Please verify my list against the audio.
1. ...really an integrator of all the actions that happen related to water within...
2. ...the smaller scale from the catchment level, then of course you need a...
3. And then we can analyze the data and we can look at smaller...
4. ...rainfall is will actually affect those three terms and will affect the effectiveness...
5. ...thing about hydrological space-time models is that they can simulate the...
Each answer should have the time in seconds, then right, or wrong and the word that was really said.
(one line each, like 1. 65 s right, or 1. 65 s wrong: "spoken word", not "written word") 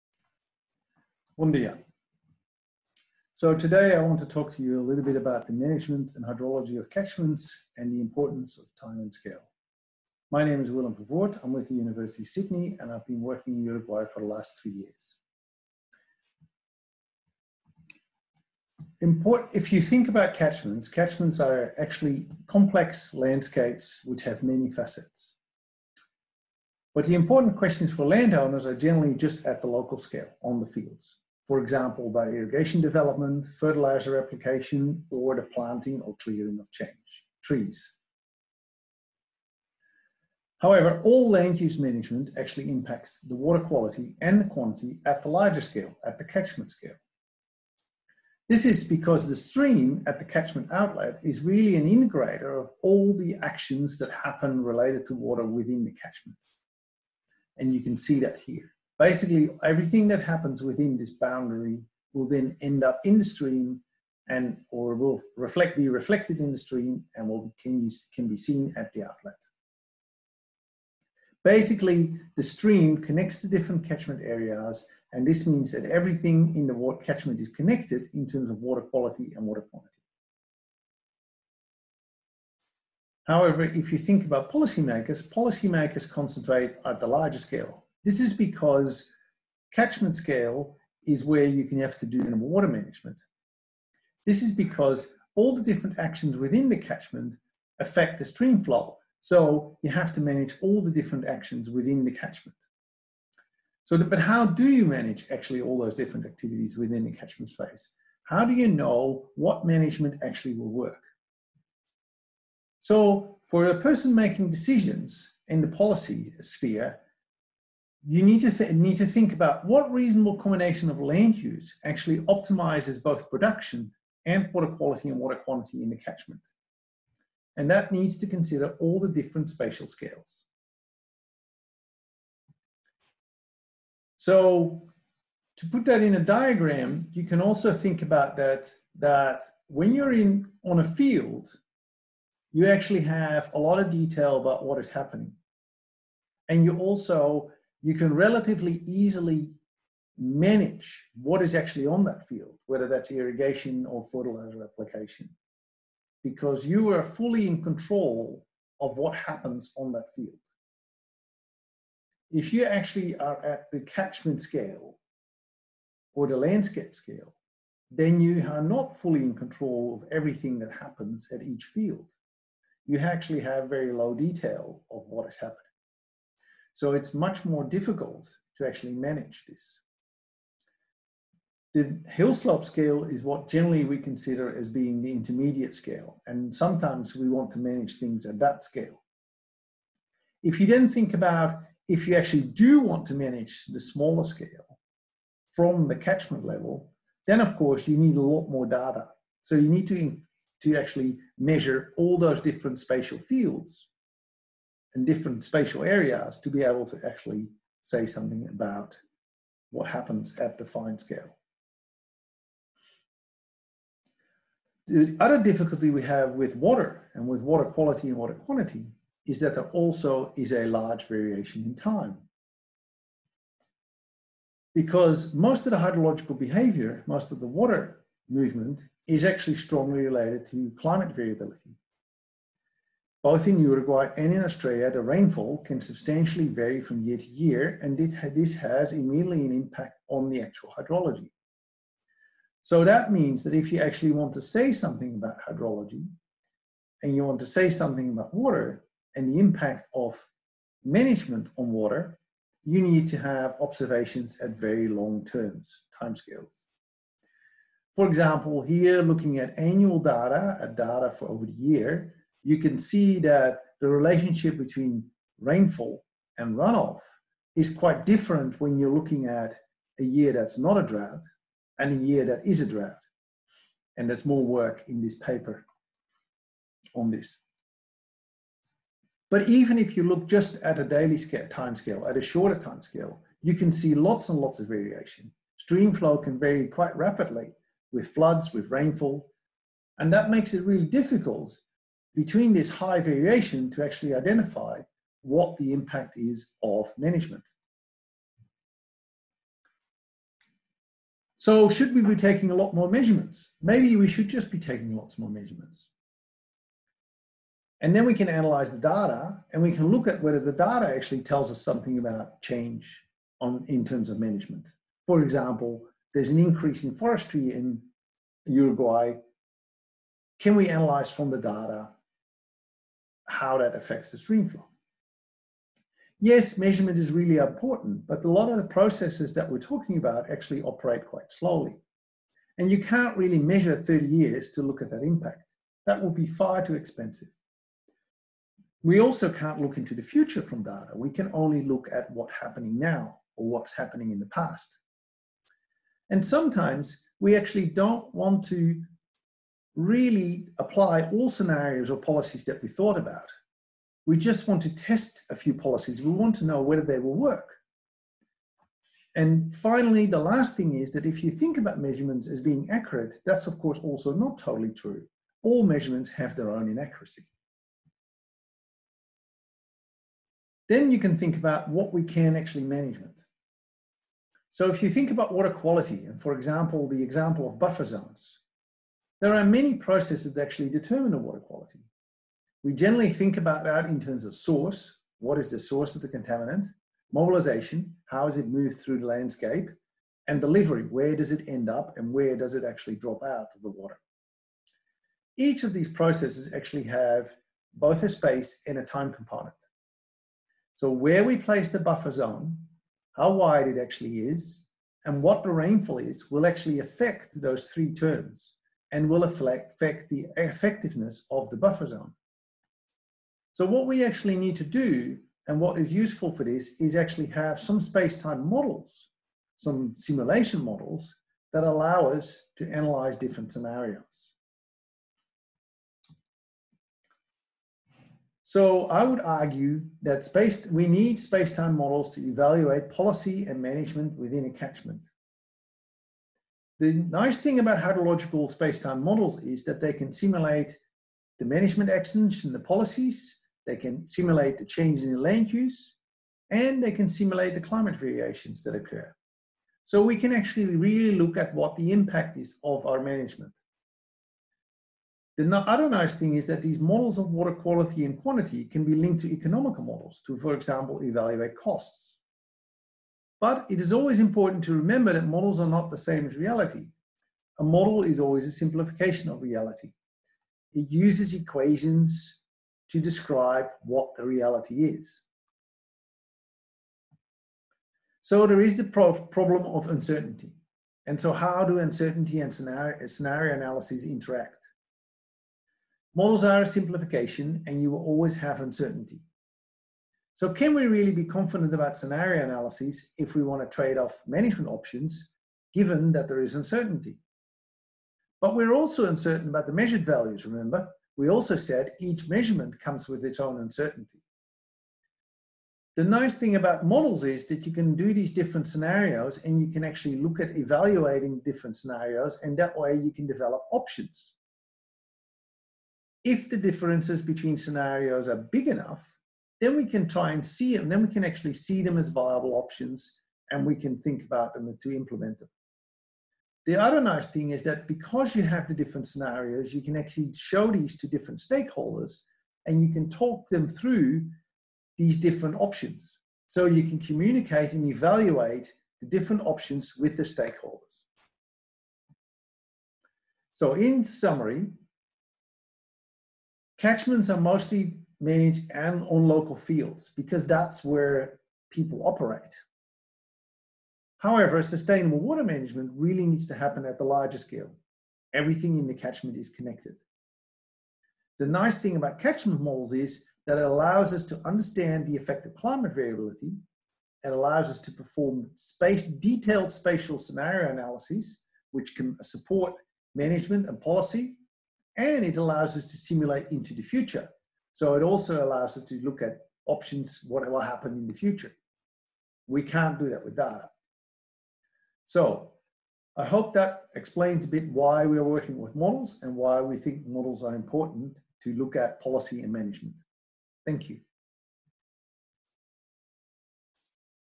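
1. 51 s right
2. 193 s right
3. 307 s wrong: "whether", not "smaller"
4. 405 s right
5. 437 s right.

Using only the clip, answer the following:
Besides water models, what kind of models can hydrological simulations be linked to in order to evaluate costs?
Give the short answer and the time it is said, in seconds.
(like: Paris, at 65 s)
economical models, at 459 s.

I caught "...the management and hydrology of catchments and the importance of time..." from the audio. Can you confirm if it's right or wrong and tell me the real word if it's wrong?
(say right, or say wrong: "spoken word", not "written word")
right.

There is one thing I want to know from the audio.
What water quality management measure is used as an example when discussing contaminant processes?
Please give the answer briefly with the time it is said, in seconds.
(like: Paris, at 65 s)
buffer zones, at 377 s.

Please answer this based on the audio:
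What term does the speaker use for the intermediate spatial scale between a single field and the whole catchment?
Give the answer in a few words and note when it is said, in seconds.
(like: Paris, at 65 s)
hill slope scale, at 182 s.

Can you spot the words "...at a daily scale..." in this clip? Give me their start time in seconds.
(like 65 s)
280 s.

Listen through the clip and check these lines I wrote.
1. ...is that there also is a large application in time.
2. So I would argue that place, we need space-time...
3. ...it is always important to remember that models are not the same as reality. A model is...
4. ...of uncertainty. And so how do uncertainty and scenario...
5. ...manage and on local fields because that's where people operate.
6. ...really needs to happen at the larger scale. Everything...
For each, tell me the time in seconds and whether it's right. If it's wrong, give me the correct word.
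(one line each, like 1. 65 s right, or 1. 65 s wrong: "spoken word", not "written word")
1. 219 s wrong: "variation", not "application"
2. 428 s wrong: "space", not "place"
3. 463 s right
4. 479 s right
5. 548 s right
6. 555 s right.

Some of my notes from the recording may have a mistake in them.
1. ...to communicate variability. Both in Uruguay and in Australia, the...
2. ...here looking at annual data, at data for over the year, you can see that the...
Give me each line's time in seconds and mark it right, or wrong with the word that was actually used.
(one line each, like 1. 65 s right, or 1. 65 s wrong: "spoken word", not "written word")
1. 230 s wrong: "climate", not "communicate"
2. 258 s right.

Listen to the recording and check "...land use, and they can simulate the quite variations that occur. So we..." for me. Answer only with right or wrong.
wrong.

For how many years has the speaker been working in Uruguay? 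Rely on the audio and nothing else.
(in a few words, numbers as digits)
3.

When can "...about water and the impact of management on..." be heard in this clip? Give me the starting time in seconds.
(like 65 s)
248 s.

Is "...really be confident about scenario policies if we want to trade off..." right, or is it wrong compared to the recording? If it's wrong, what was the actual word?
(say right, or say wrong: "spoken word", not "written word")
wrong: "analyses", not "policies".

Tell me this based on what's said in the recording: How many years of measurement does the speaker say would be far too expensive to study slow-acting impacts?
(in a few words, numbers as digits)
30.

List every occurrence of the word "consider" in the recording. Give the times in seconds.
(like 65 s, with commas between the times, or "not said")
128 s, 183 s.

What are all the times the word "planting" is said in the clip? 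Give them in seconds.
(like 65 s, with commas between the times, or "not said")
35 s.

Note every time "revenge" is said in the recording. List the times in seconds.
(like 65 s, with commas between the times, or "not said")
not said.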